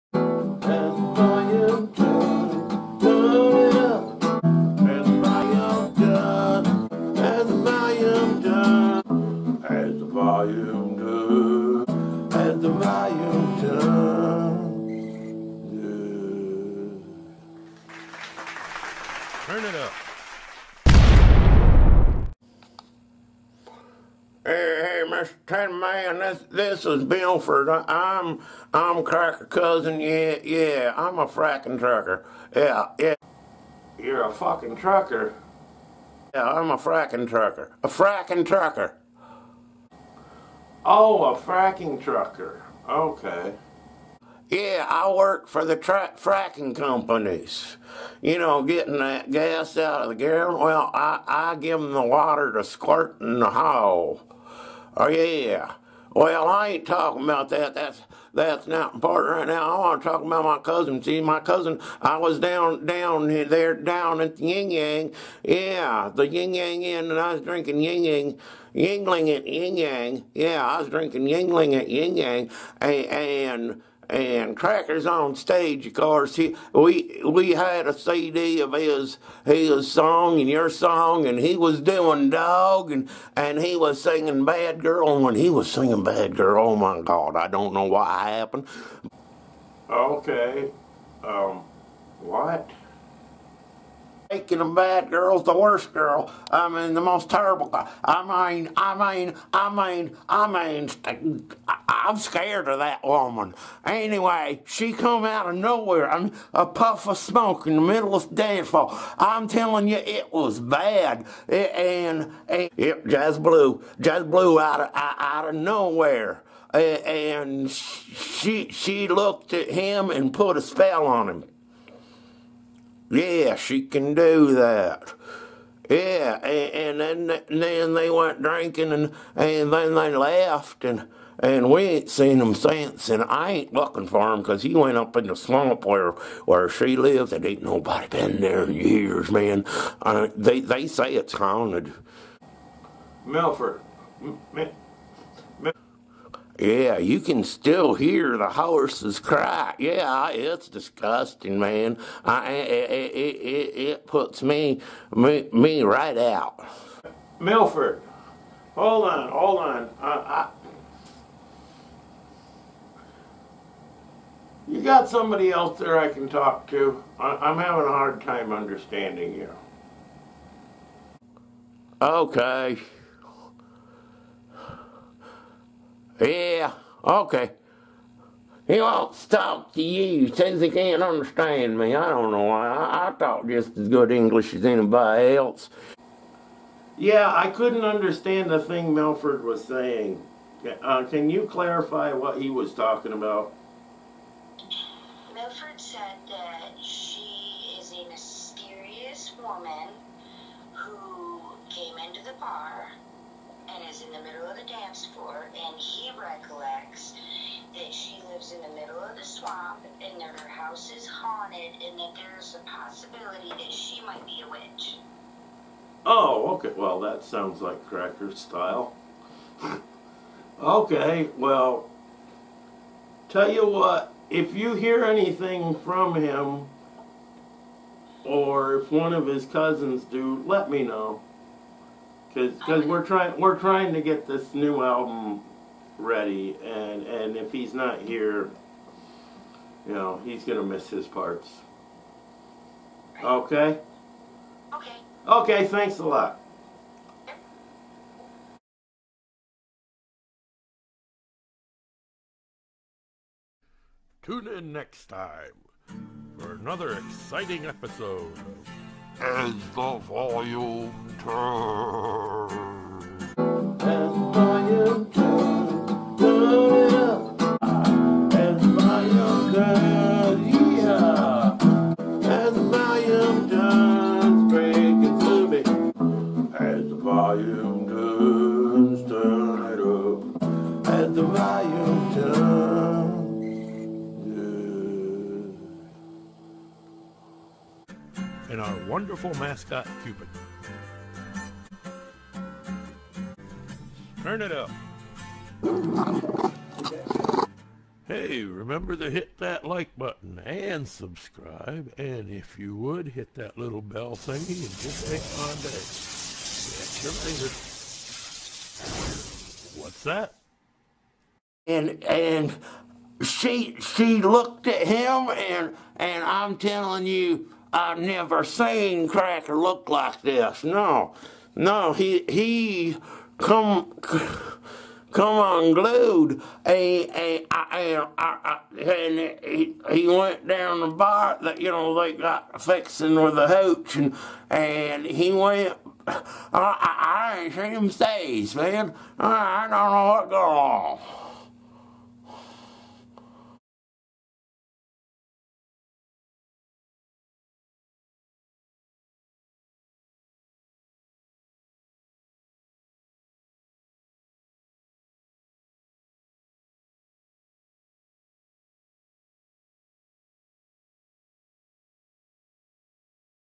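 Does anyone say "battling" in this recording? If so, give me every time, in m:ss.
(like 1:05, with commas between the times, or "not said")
not said.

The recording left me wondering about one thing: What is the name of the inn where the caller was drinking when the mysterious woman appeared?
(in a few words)
Yin Yang Inn.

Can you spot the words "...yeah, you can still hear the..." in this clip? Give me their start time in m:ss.
2:26.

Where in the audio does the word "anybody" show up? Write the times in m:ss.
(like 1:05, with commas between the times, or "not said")
3:04.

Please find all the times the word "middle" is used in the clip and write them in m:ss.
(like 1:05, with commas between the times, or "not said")
1:47, 3:24, 3:28.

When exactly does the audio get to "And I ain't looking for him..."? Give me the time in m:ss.
2:13.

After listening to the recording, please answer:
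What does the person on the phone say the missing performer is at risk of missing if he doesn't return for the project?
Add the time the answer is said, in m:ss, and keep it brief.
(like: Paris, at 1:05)
his parts, at 4:00.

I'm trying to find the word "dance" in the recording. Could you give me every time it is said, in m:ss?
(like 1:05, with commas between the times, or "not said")
1:48, 3:24.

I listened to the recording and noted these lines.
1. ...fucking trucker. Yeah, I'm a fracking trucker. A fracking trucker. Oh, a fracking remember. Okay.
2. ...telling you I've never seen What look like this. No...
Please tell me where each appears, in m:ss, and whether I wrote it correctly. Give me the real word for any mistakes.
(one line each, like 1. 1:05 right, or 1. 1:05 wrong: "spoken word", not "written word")
1. 0:34 wrong: "trucker", not "remember"
2. 5:16 wrong: "Cracker", not "What".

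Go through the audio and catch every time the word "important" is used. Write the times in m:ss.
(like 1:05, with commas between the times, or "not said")
0:58.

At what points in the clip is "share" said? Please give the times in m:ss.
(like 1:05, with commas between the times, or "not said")
not said.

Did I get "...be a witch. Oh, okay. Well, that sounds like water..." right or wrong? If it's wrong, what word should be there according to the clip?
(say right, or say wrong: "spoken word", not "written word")
wrong: "cracker", not "water".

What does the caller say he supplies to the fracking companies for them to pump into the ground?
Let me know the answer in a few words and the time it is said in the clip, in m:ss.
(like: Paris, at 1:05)
water, at 0:52.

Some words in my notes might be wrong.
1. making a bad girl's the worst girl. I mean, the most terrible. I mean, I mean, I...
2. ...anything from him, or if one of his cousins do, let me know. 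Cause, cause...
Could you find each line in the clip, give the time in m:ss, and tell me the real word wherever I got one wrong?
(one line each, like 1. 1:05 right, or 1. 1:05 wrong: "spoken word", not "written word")
1. 1:34 right
2. 3:45 right.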